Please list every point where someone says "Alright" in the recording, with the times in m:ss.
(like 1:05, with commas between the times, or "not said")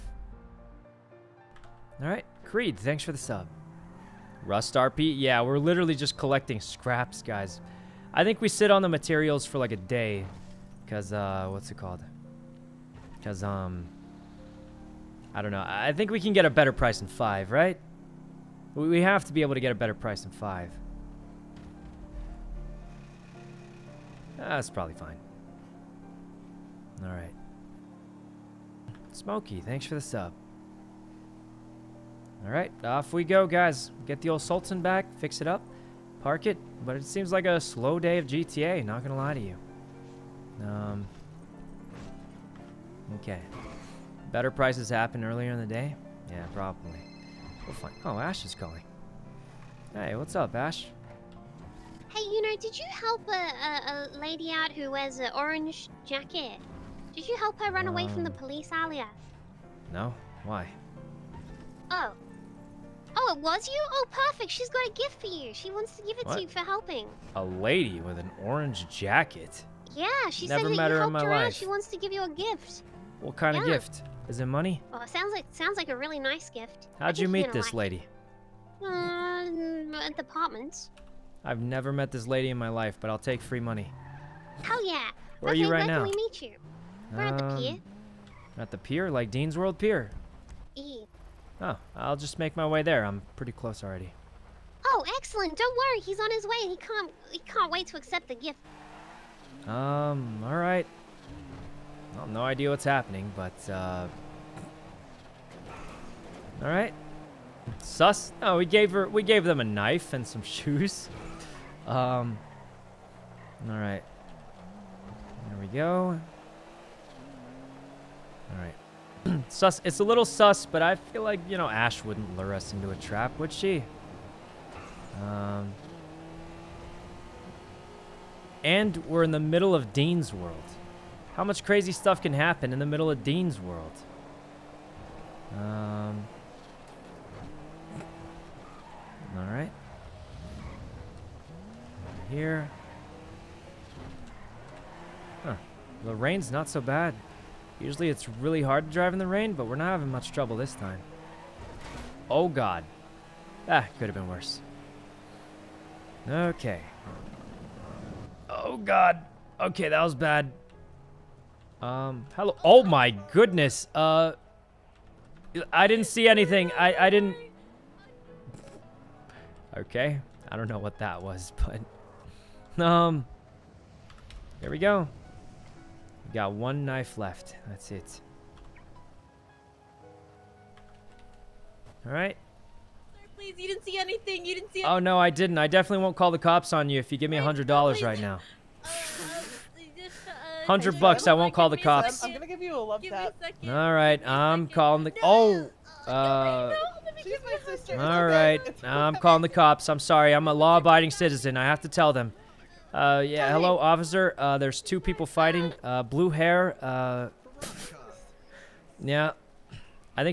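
0:27, 3:02.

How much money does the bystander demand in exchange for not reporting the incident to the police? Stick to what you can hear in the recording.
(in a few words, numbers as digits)
$100.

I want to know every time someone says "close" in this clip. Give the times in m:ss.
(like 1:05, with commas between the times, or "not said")
1:33.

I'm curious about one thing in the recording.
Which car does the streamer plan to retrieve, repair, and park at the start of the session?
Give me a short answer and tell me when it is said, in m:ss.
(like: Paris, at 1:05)
Sultan, at 0:34.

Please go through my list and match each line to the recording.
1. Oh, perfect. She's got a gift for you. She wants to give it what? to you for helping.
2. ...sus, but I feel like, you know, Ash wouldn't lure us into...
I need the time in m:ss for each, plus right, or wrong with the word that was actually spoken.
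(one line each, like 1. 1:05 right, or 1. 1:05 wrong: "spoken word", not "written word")
1. 1:03 right
2. 2:00 right.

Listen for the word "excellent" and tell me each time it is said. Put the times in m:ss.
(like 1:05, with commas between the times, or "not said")
1:35.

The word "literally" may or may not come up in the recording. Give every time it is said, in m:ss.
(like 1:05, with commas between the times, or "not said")
0:05.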